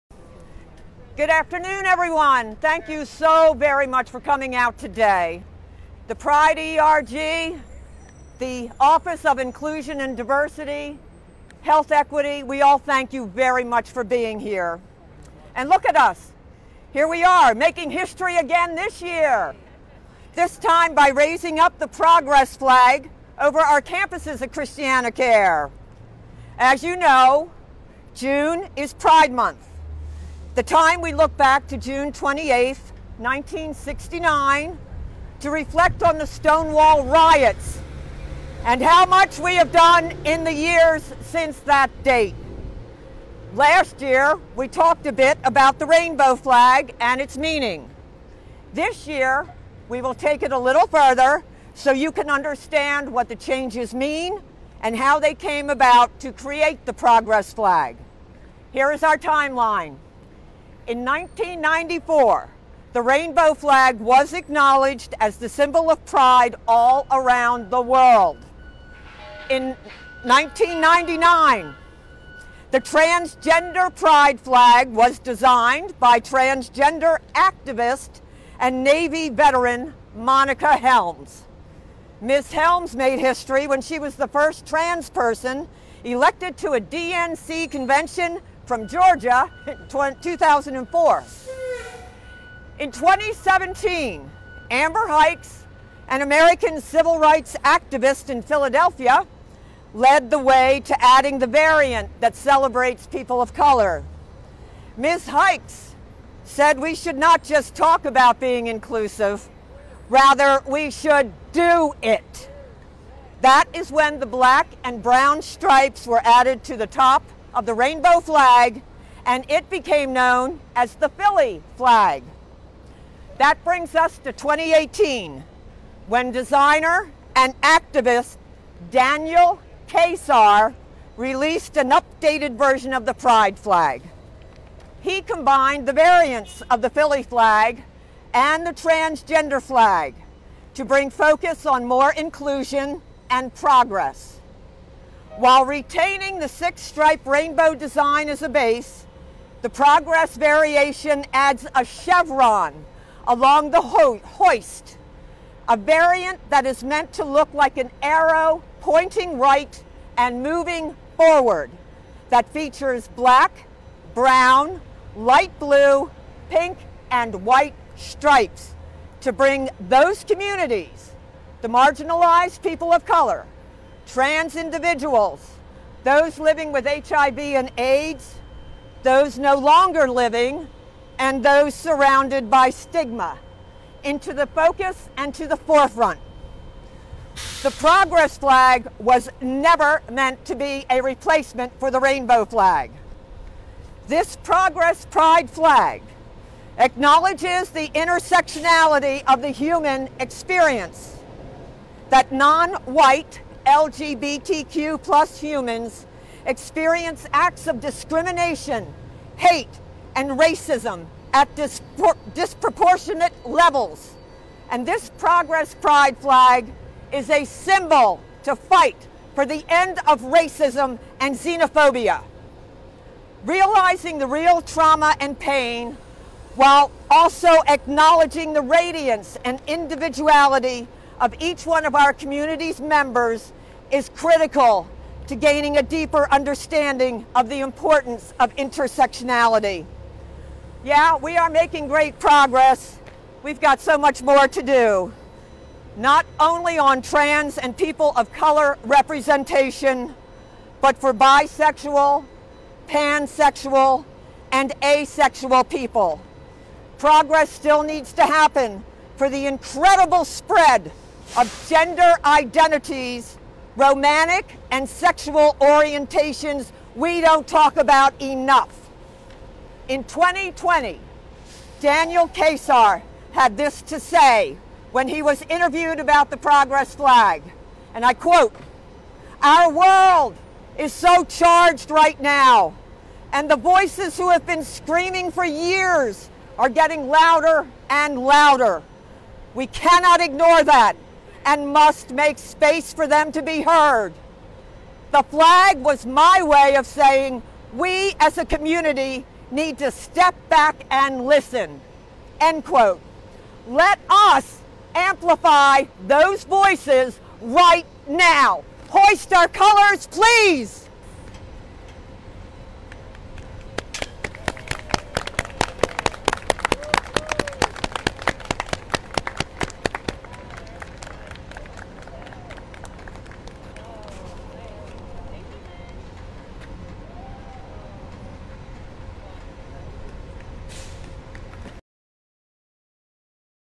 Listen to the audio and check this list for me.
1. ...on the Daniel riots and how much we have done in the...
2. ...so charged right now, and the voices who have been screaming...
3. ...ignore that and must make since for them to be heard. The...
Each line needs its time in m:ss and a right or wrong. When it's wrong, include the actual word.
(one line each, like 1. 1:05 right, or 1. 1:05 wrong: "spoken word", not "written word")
1. 0:36 wrong: "Stonewall", not "Daniel"
2. 4:40 right
3. 4:50 wrong: "space", not "since".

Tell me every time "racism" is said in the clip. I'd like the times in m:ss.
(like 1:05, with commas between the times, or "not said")
3:30, 3:40.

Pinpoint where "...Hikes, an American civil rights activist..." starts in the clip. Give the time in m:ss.
1:35.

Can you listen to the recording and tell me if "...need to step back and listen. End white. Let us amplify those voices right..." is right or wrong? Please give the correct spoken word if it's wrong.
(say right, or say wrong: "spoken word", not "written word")
wrong: "quote", not "white".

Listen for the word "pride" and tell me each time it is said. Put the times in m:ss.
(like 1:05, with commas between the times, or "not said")
0:06, 0:28, 1:06, 1:13, 2:13, 3:15, 3:35.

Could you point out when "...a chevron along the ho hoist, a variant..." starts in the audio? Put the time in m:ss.
2:31.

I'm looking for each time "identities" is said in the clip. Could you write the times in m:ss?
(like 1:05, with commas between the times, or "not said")
4:22.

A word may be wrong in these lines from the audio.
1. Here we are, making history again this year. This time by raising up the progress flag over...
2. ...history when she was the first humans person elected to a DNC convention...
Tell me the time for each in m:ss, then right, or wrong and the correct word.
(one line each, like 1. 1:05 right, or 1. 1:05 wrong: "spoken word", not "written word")
1. 0:16 right
2. 1:23 wrong: "trans", not "humans".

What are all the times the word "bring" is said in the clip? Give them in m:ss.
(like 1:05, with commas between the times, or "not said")
2:03, 2:20, 2:49.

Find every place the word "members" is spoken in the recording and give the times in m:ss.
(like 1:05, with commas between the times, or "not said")
3:52.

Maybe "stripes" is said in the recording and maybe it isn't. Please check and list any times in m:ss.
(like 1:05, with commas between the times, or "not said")
1:55, 2:26, 2:47.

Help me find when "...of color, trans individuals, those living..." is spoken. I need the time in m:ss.
2:52.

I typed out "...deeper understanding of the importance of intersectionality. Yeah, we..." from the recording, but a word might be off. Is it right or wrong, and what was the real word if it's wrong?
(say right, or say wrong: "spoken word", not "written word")
right.